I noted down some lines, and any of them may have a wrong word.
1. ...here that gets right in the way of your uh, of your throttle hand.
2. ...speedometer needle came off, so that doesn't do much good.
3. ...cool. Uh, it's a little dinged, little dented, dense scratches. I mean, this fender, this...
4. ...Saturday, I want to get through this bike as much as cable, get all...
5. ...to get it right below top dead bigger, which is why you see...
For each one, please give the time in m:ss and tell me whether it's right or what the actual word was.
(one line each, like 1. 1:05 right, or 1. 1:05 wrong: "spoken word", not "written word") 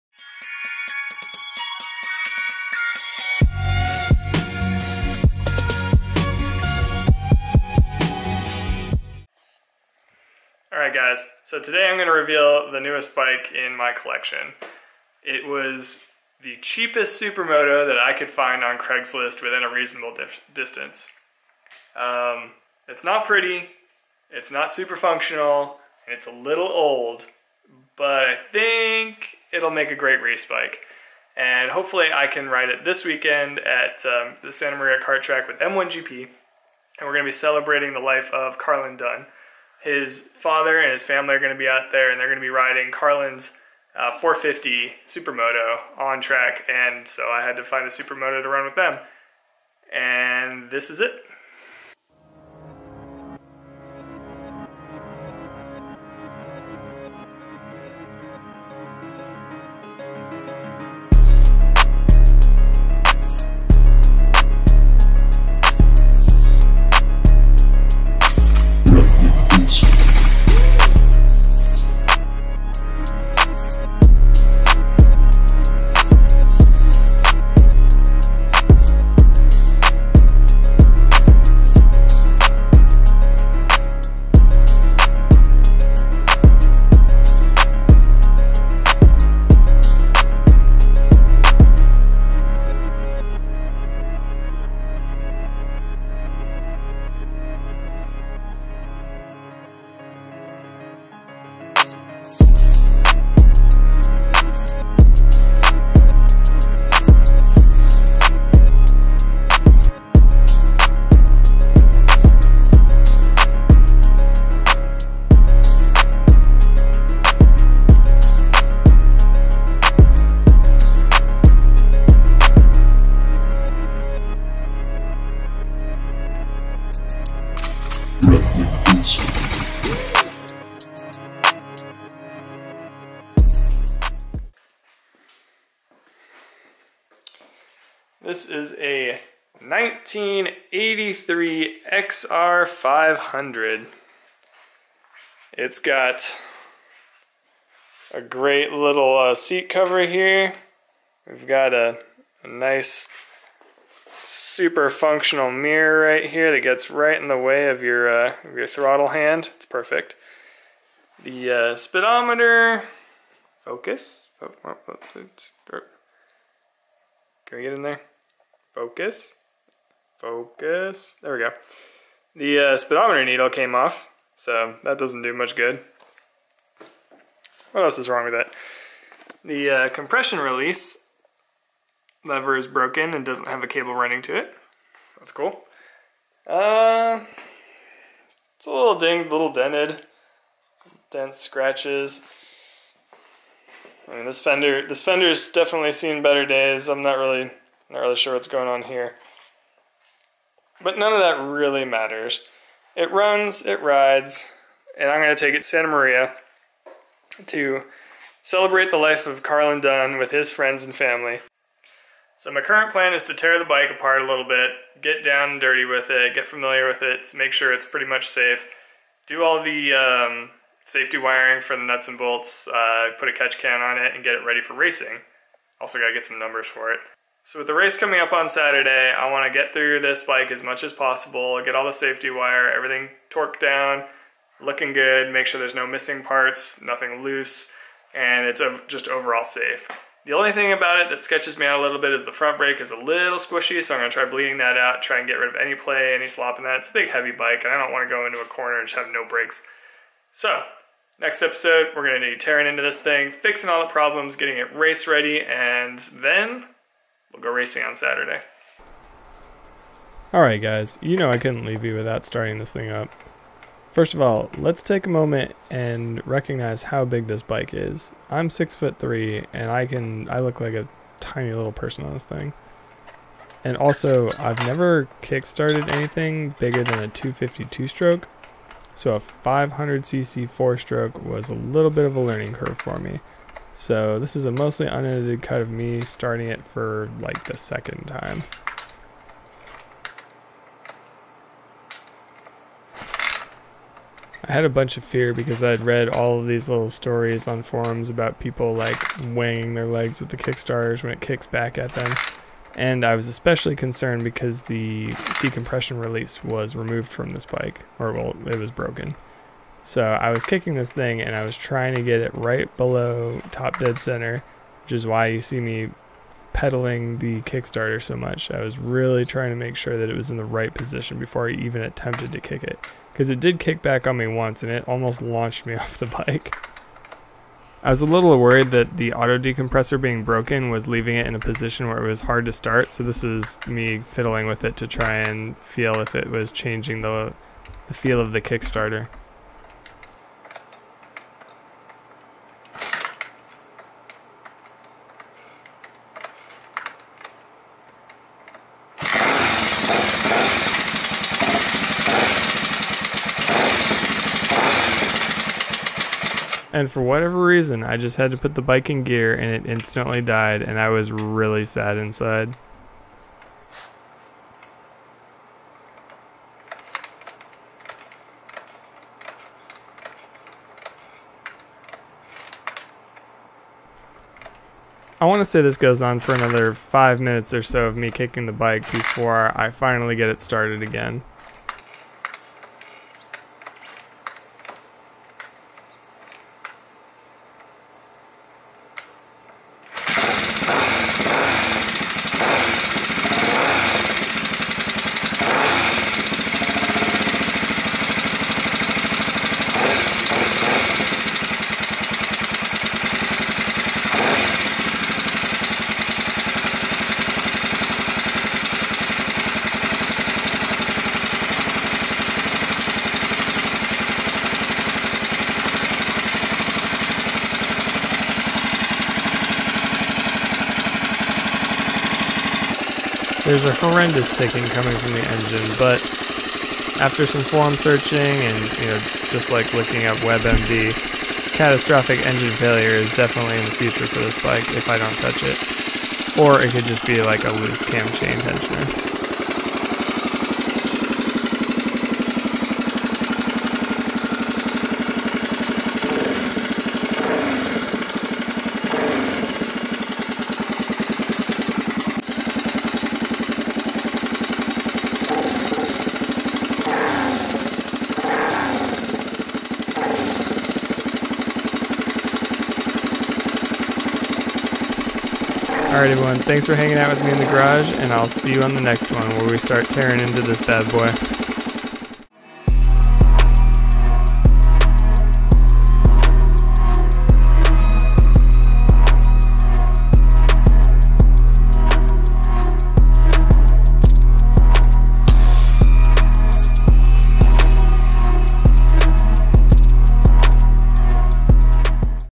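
1. 2:36 right
2. 2:52 right
3. 3:05 right
4. 3:48 wrong: "possible", not "cable"
5. 5:11 wrong: "center", not "bigger".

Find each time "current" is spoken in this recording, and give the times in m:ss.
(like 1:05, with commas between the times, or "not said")
3:32.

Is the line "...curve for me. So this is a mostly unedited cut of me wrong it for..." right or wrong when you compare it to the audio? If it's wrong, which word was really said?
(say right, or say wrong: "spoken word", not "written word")
wrong: "starting", not "wrong".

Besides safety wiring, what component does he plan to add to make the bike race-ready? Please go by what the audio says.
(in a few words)
catch can.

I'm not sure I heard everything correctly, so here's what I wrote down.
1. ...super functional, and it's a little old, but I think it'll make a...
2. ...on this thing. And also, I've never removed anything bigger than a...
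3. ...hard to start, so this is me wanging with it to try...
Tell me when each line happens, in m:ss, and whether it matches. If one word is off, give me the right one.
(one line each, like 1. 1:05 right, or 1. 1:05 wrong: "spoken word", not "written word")
1. 0:24 right
2. 4:32 wrong: "kickstarted", not "removed"
3. 5:32 wrong: "fiddling", not "wanging".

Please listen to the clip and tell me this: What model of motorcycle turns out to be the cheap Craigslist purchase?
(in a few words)
XR500.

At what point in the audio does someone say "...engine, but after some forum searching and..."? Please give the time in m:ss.
7:05.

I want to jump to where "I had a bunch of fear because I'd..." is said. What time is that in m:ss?
4:54.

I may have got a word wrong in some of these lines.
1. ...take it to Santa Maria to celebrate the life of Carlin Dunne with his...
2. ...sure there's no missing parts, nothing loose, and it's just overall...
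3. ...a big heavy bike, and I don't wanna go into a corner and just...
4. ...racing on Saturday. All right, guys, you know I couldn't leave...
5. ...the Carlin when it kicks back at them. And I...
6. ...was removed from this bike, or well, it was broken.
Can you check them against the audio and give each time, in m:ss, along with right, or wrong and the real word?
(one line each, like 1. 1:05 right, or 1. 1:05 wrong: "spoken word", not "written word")
1. 3:25 right
2. 3:55 right
3. 4:06 right
4. 4:17 right
5. 5:00 wrong: "Kickstarters", not "Carlin"
6. 5:06 right.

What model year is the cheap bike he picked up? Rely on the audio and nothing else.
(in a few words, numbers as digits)
1983.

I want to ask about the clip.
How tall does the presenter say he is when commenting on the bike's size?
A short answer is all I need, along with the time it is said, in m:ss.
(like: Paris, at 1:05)
6 foot 3, at 4:28.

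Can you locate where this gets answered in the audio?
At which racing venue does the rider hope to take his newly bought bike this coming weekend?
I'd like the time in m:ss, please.
0:34.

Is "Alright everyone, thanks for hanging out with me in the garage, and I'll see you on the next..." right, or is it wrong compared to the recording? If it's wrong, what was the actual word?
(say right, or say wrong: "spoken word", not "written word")
right.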